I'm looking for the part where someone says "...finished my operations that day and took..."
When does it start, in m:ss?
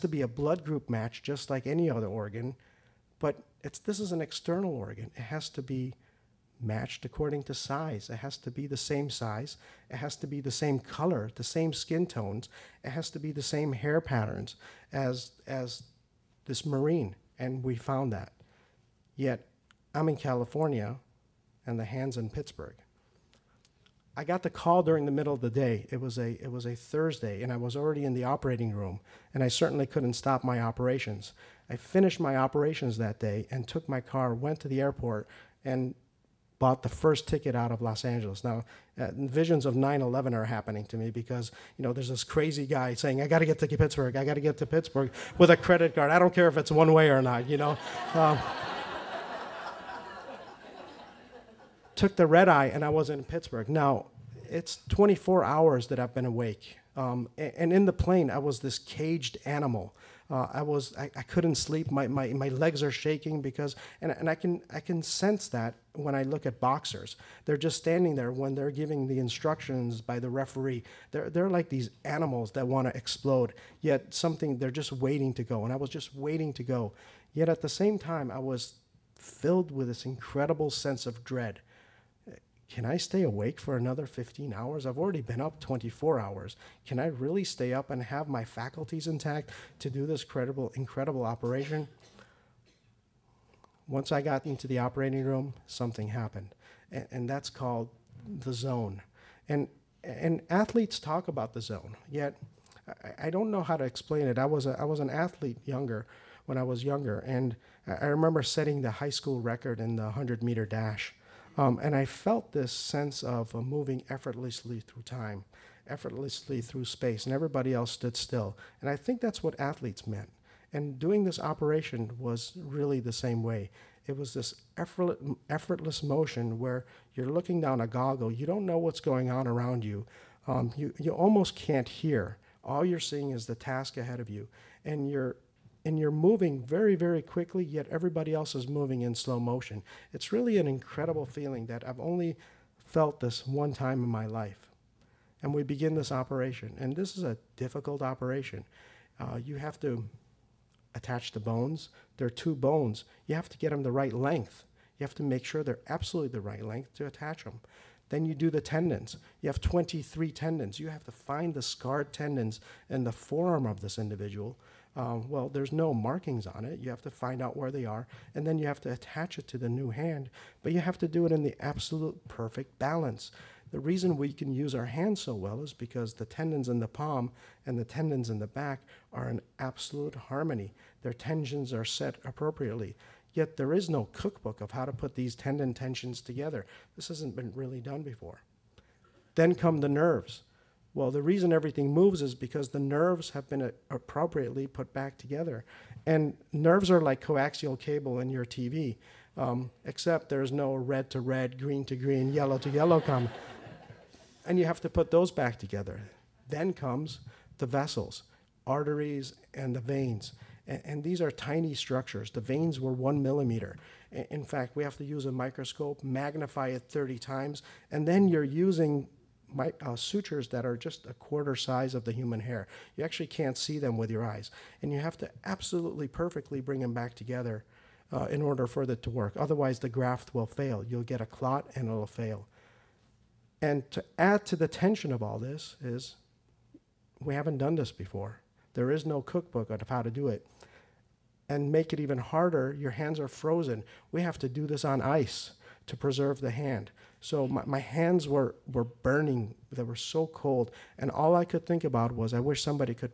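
0:31.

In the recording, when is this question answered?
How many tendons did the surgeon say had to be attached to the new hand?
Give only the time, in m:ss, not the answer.
2:39.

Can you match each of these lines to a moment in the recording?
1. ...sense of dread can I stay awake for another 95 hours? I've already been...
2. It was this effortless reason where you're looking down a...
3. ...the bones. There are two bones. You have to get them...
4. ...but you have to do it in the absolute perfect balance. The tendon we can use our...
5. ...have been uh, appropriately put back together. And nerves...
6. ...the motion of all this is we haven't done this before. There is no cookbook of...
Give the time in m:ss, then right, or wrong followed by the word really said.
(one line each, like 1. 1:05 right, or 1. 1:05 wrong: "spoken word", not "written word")
1. 1:20 wrong: "15", not "95"
2. 2:04 wrong: "motion", not "reason"
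3. 2:31 right
4. 2:50 wrong: "reason", not "tendon"
5. 3:13 right
6. 3:54 wrong: "tension", not "motion".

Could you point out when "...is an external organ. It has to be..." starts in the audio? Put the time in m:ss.
0:04.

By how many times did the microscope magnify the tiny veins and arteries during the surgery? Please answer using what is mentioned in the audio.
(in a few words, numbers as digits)
30.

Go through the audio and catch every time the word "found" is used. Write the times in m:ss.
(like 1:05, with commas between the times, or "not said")
0:17.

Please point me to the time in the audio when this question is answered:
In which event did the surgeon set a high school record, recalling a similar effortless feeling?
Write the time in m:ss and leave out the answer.
1:50.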